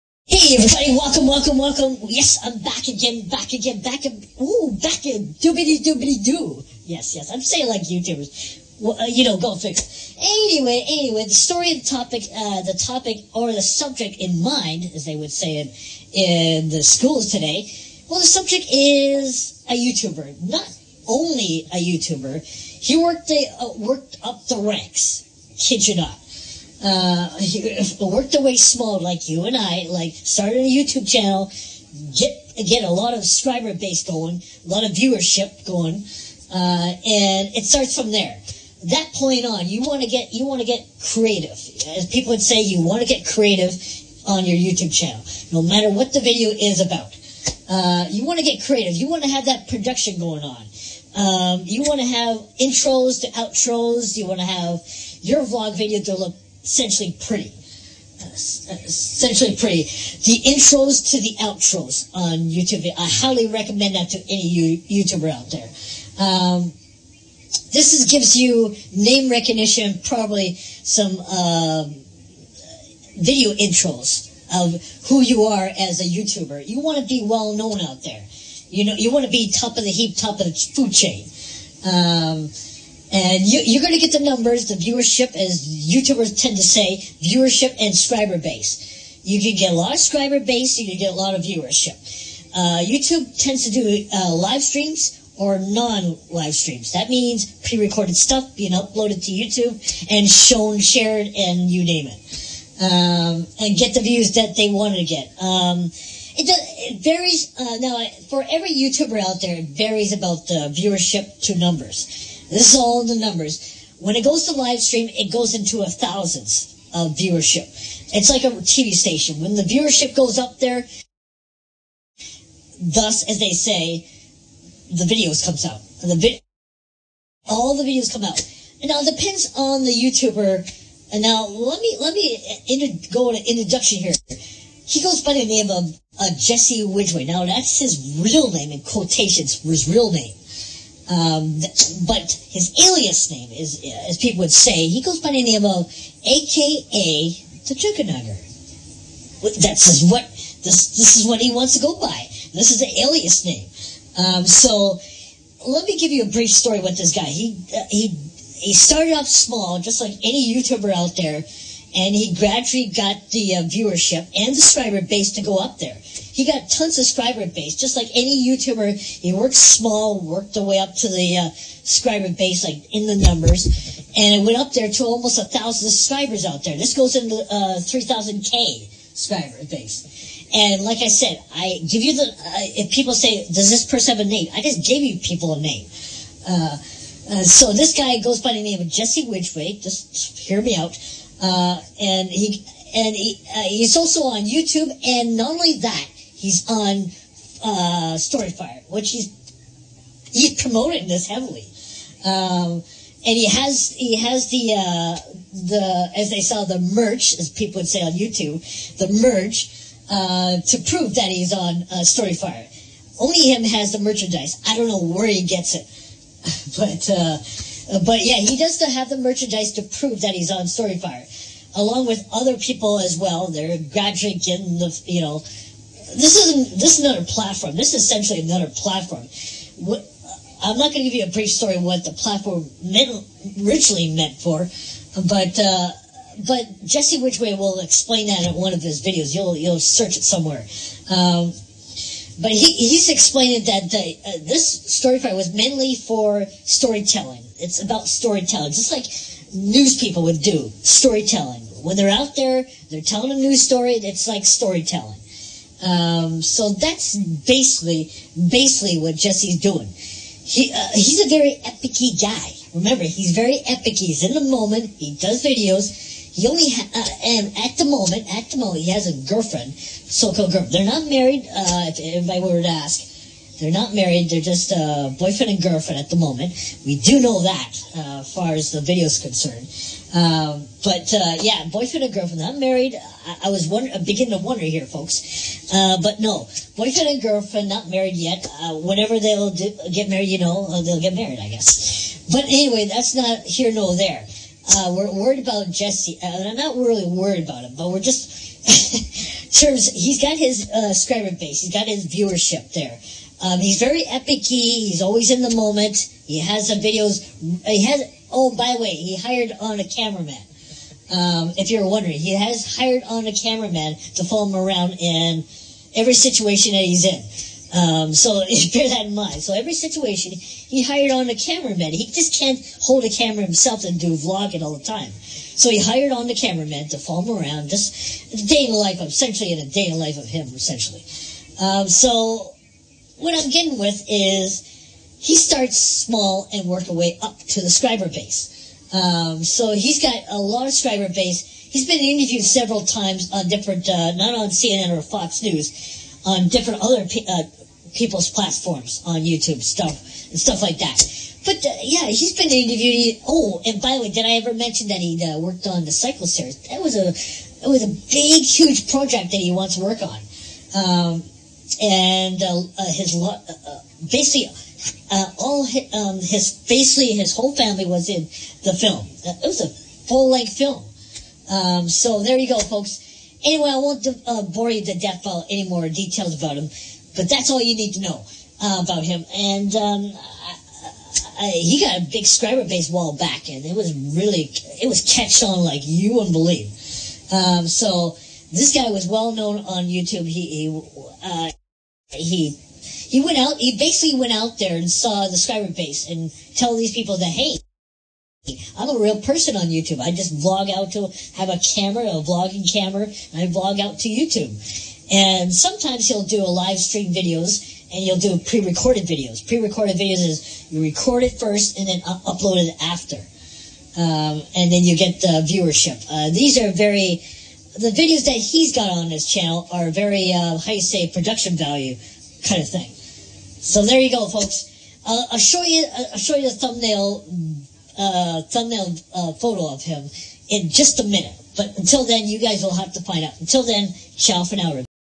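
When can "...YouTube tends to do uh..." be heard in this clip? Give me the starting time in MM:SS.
01:32.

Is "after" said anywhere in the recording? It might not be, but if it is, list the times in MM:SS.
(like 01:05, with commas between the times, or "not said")
06:52.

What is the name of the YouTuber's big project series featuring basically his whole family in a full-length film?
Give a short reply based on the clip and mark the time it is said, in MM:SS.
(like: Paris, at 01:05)
Psycho series, at 05:55.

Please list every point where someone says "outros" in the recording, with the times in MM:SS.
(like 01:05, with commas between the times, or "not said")
00:53, 01:01.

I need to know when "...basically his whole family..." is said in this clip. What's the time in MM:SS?
06:06.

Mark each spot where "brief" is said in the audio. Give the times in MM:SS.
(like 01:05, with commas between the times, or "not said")
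02:36, 03:51.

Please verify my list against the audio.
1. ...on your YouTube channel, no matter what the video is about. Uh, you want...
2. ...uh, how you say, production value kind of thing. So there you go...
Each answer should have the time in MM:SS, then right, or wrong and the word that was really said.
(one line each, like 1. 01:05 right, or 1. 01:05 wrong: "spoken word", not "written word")
1. 00:44 right
2. 07:00 right.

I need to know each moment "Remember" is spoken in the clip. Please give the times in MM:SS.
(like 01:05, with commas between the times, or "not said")
04:22.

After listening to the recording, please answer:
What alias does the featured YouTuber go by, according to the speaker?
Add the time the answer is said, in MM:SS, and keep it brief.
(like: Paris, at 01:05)
the Chukanugger, at 02:27.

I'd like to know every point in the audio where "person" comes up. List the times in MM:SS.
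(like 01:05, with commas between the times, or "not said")
03:03, 06:39.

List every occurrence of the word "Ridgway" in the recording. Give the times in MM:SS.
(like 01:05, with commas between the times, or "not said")
02:16, 03:09, 03:57.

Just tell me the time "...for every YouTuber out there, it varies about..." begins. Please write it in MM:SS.
01:48.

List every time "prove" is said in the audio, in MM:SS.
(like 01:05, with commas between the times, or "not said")
03:30, 03:39.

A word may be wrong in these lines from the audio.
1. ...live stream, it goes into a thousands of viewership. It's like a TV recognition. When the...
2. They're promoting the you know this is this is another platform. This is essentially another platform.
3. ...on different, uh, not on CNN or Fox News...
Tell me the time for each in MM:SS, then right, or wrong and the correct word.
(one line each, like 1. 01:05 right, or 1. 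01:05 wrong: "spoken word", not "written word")
1. 01:54 wrong: "station", not "recognition"
2. 03:43 wrong: "graduating", not "promoting"
3. 05:43 right.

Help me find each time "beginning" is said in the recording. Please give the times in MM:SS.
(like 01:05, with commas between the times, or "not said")
04:44.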